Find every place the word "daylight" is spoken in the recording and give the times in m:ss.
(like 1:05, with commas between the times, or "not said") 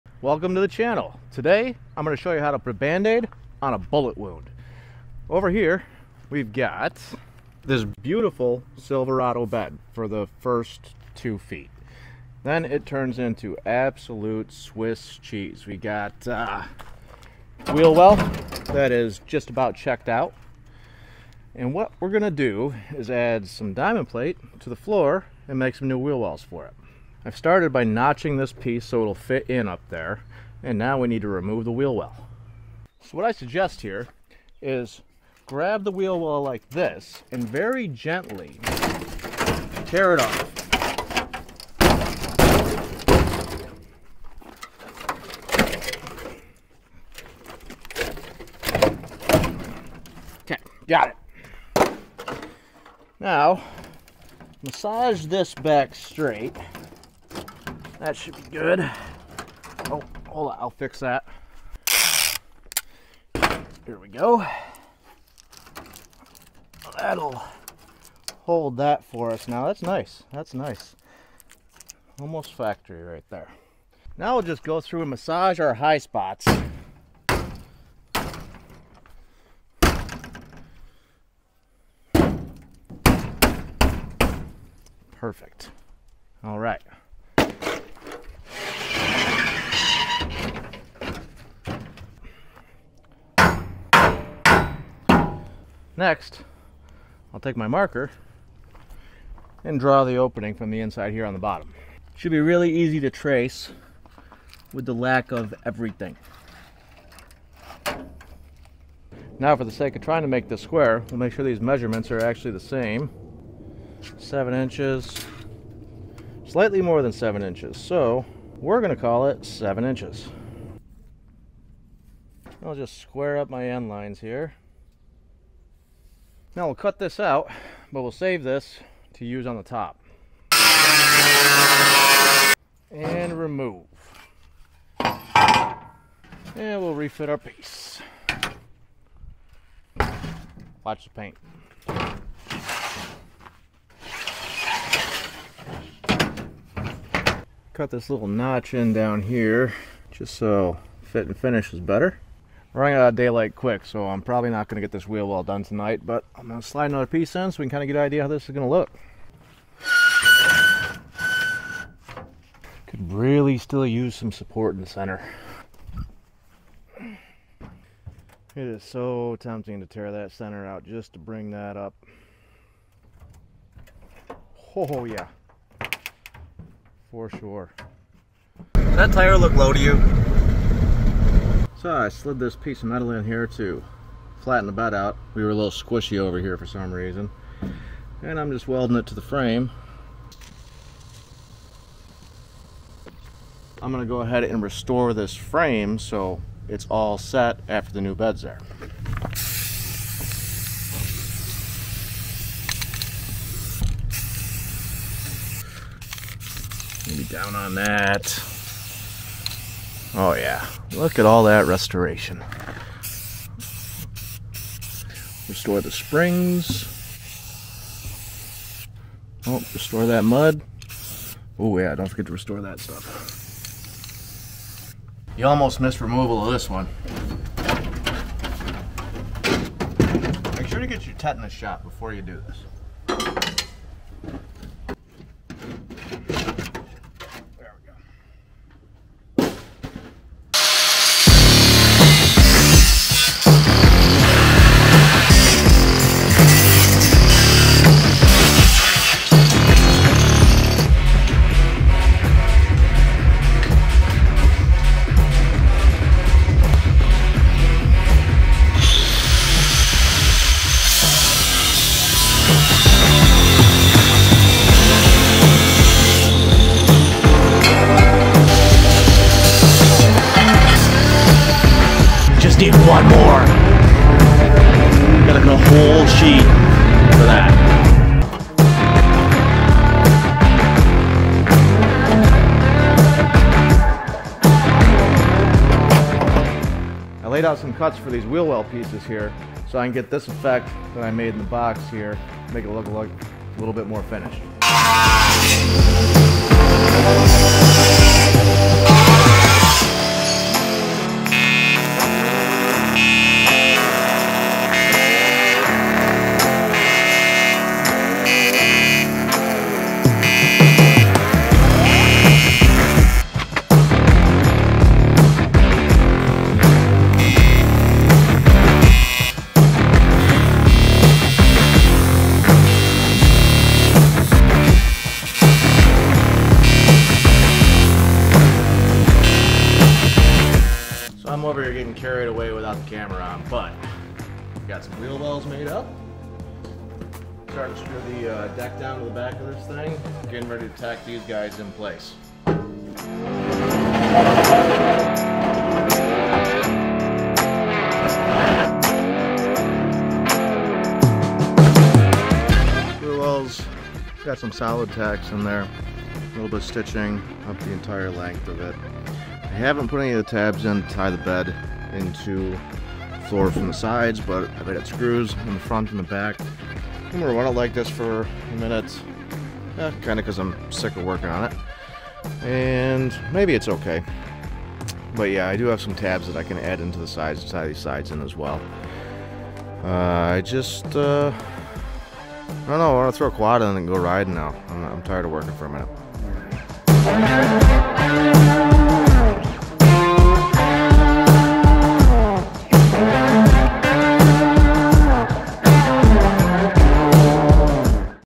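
2:33.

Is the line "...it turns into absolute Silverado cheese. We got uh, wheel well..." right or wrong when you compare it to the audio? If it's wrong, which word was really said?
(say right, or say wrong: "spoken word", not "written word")
wrong: "Swiss", not "Silverado".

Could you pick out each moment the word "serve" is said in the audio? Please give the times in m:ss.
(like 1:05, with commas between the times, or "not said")
not said.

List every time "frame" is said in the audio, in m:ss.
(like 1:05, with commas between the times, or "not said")
3:09, 3:15.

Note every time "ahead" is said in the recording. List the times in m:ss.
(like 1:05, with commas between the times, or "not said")
3:14.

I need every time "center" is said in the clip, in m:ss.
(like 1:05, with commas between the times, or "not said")
2:44, 2:50.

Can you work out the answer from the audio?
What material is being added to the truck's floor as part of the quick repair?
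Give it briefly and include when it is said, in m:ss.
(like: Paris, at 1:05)
Diamond plate, at 0:23.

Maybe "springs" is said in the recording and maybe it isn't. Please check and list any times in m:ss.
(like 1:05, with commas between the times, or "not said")
3:35.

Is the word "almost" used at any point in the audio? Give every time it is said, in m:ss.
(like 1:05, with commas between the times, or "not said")
1:12, 3:45.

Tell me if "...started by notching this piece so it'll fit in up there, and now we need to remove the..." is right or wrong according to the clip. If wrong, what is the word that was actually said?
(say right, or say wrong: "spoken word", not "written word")
right.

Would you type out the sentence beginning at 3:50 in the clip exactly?
Make sure to get your tetanus shot before you do this.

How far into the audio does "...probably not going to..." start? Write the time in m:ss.
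2:34.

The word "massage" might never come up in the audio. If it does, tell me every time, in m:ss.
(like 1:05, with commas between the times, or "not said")
0:54, 1:15.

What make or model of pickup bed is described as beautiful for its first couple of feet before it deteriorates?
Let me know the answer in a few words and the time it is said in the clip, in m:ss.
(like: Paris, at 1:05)
Silverado, at 0:08.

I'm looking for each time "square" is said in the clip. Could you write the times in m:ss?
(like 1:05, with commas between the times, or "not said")
1:50, 2:02.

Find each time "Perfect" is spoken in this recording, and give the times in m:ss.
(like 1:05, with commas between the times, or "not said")
1:25.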